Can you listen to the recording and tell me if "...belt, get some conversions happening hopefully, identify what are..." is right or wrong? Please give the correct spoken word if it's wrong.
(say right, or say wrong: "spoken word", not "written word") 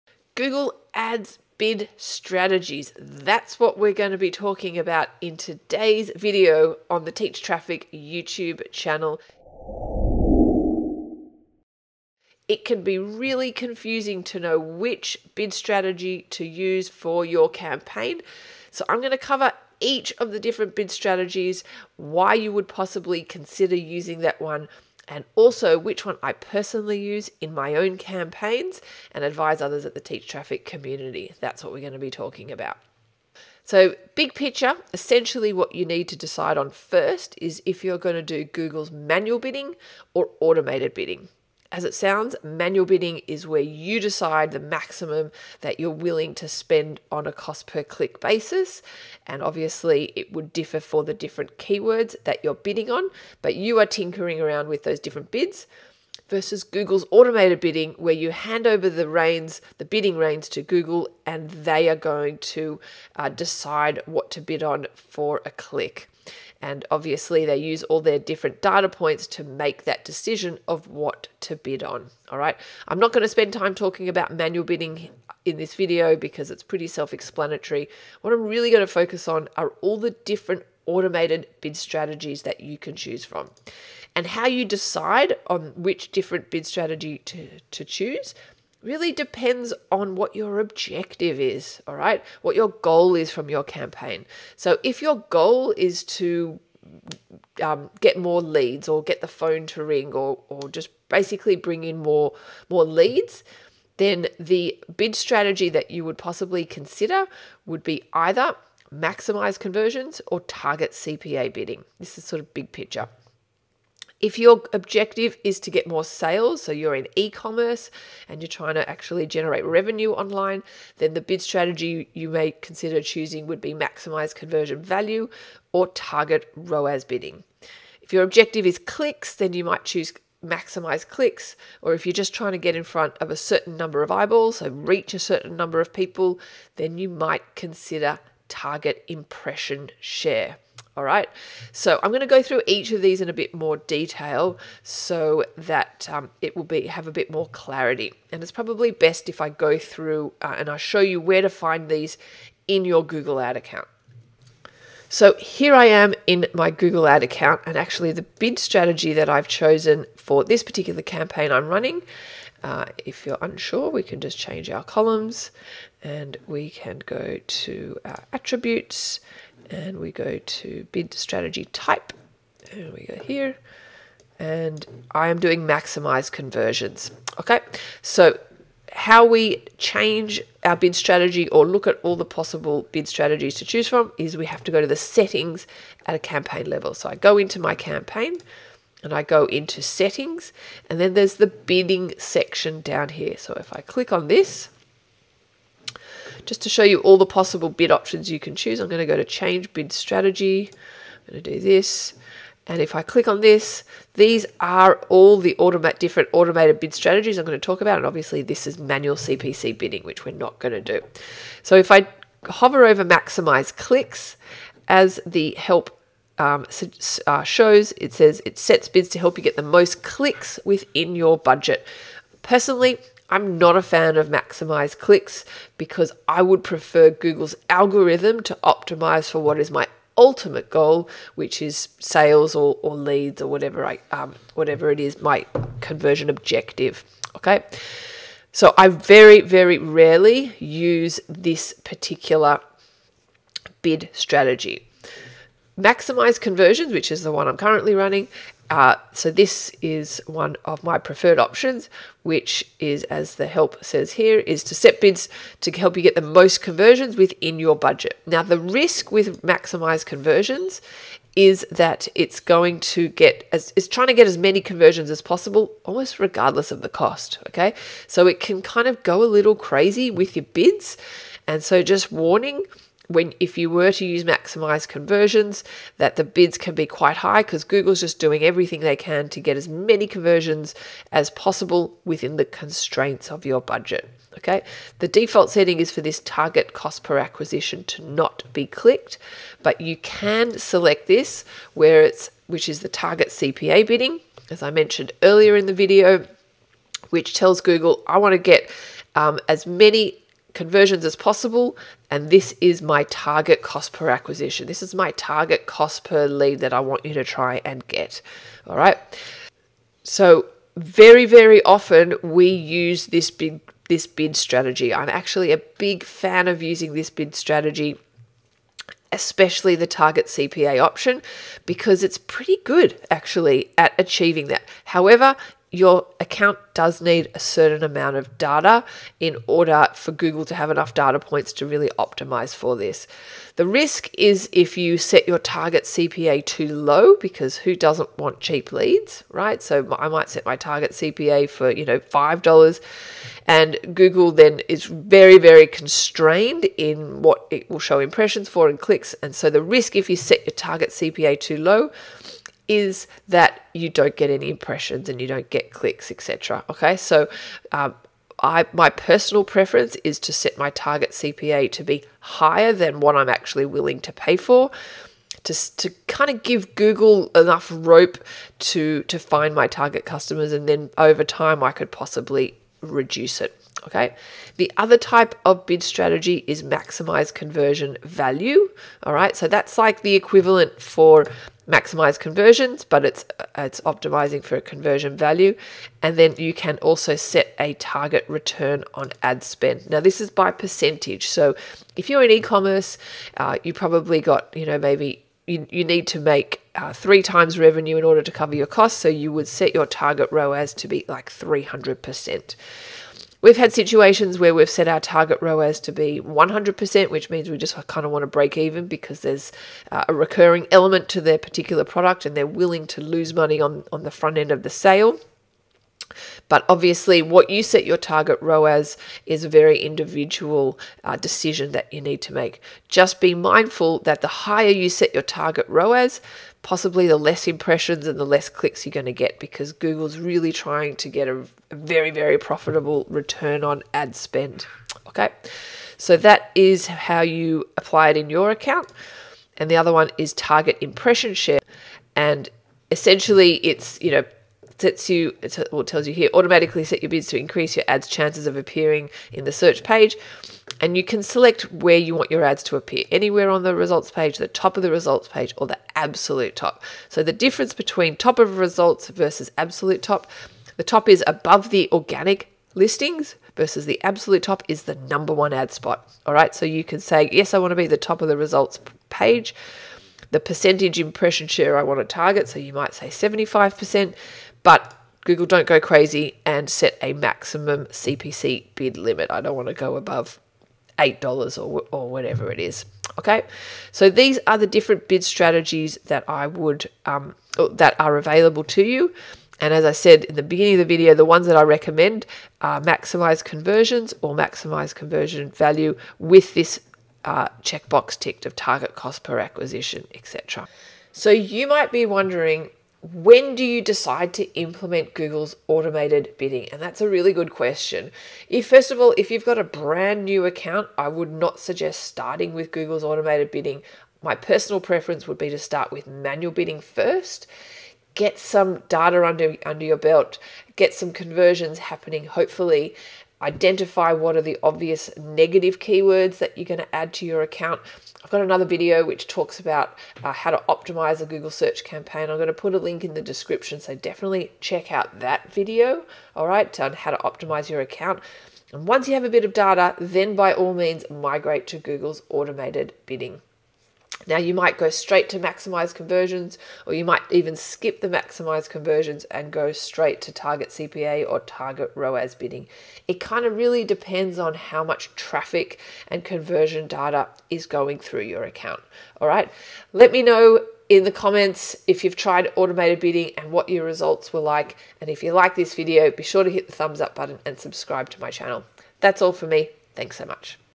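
right.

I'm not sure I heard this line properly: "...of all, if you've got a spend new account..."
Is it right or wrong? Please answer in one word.
wrong.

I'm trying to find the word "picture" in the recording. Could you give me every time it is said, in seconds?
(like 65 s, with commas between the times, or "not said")
34 s, 112 s.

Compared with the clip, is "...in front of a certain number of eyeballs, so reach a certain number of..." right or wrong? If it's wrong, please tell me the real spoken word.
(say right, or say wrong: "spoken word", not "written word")
right.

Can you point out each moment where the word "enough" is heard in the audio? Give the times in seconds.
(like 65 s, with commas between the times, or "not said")
330 s, 367 s.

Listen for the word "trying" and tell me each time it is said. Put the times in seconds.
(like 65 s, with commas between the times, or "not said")
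118 s, 132 s, 263 s, 430 s.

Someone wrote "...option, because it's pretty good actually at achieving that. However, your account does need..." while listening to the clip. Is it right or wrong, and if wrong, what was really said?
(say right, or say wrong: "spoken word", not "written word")
right.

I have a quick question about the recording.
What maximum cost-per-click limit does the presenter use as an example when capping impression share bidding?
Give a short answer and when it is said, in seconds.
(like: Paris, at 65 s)
$8, at 480 s.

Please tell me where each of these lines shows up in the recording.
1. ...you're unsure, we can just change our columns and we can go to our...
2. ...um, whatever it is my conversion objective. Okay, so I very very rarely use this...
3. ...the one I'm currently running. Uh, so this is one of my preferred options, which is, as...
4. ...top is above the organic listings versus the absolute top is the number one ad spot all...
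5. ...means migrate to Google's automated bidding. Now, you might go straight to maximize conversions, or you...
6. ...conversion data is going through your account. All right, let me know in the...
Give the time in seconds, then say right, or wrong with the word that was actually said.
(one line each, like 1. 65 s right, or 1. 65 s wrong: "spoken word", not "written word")
1. 163 s right
2. 234 s right
3. 247 s right
4. 460 s right
5. 540 s right
6. 556 s right.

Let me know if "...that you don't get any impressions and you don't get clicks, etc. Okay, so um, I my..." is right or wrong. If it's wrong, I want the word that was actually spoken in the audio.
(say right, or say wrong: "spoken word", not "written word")
right.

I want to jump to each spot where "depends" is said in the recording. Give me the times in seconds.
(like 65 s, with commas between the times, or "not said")
89 s, 553 s.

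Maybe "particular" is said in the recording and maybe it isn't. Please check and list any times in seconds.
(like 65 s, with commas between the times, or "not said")
160 s, 241 s, 411 s.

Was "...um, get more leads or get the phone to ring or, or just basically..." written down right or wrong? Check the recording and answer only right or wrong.
right.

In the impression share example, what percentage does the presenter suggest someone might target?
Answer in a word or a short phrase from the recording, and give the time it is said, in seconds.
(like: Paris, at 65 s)
75%, at 473 s.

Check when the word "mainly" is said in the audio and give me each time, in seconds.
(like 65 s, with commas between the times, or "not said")
not said.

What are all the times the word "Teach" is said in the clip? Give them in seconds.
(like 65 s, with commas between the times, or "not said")
7 s, 29 s.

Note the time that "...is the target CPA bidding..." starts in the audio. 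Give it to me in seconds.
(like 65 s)
292 s.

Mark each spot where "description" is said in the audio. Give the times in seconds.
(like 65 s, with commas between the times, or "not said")
533 s.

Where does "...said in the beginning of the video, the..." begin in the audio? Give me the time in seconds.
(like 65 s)
489 s.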